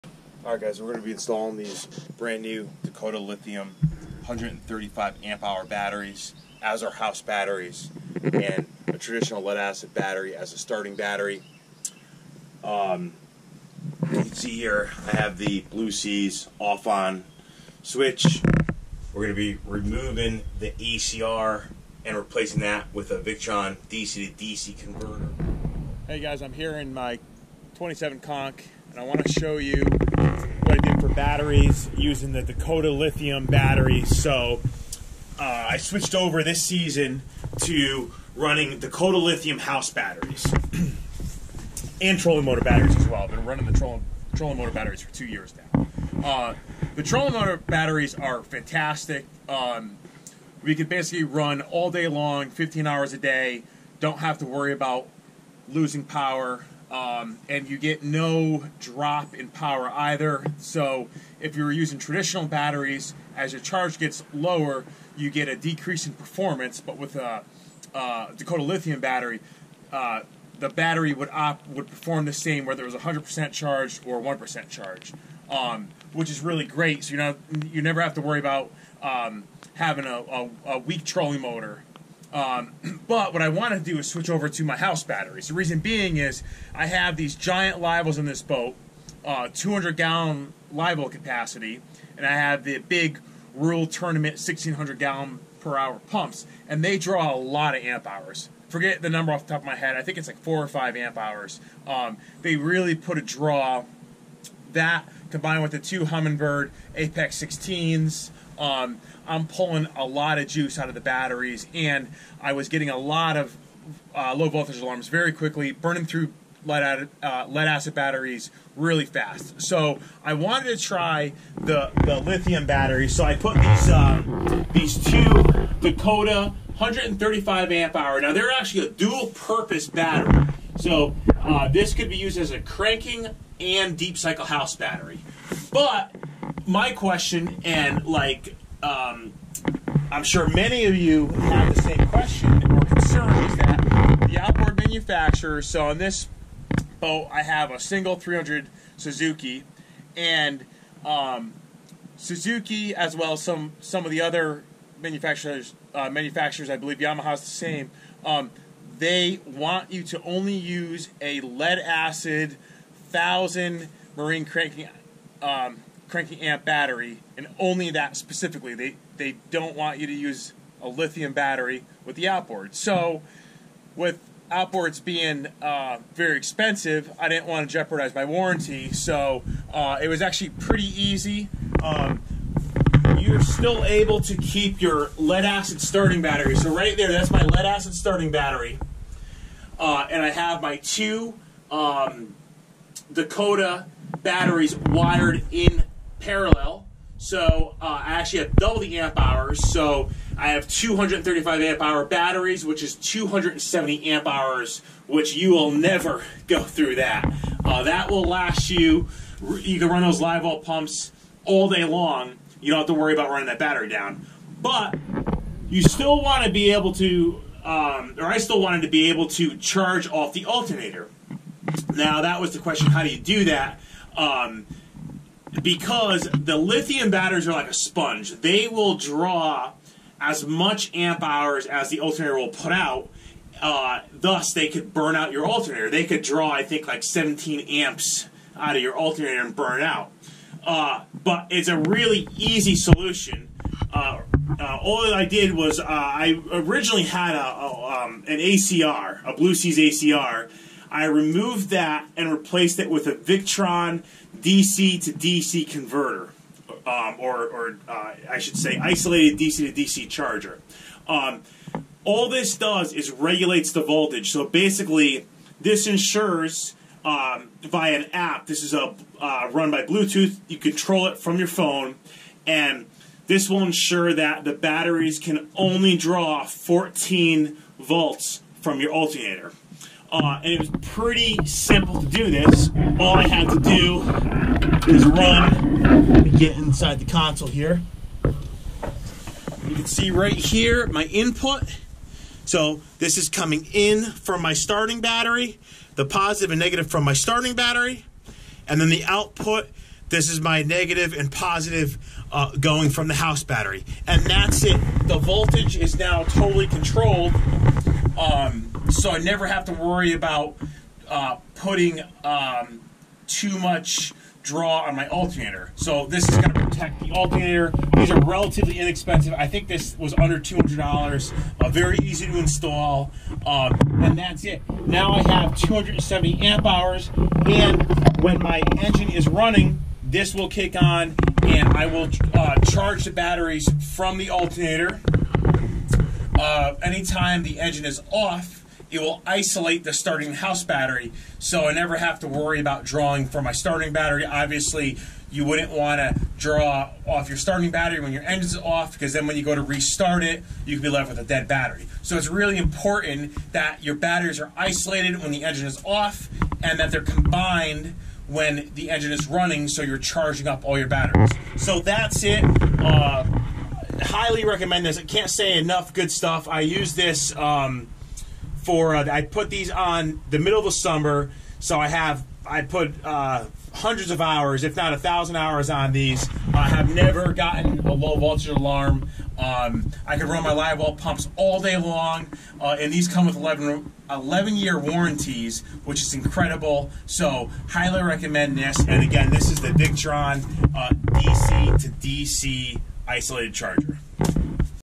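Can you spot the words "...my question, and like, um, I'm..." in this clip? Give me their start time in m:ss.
2:16.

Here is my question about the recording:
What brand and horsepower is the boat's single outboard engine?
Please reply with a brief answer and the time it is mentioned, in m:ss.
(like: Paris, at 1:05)
300 Suzuki, at 2:28.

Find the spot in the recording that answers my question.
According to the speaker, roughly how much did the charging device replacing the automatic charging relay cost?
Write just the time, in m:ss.
5:20.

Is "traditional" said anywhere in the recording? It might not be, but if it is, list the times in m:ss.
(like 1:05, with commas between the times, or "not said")
0:08, 1:01.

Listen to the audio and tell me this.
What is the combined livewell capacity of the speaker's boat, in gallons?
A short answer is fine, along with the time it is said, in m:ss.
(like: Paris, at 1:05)
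200 gallons, at 1:29.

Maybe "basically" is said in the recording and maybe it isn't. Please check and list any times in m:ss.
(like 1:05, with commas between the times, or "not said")
0:50, 4:24.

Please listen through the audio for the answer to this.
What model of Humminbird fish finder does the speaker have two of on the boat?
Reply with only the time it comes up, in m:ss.
1:46.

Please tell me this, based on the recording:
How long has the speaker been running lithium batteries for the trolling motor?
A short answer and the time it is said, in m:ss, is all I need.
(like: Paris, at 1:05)
2 years, at 0:45.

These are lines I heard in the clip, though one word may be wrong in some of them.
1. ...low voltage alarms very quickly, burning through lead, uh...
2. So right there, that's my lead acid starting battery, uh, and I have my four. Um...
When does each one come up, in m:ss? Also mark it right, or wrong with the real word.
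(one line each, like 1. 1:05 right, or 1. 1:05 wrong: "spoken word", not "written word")
1. 1:54 right
2. 3:06 wrong: "two", not "four".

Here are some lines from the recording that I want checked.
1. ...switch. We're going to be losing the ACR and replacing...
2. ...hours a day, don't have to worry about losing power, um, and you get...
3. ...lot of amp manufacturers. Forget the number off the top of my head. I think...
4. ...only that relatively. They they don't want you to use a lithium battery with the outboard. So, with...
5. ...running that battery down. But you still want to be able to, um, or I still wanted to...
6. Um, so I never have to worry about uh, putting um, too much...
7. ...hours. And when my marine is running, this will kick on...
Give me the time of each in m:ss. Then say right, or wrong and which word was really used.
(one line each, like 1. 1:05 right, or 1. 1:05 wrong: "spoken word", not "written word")
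1. 0:17 wrong: "removing", not "losing"
2. 0:52 right
3. 1:37 wrong: "hours", not "manufacturers"
4. 2:47 wrong: "specifically", not "relatively"
5. 3:33 right
6. 5:08 right
7. 5:26 wrong: "engine", not "marine".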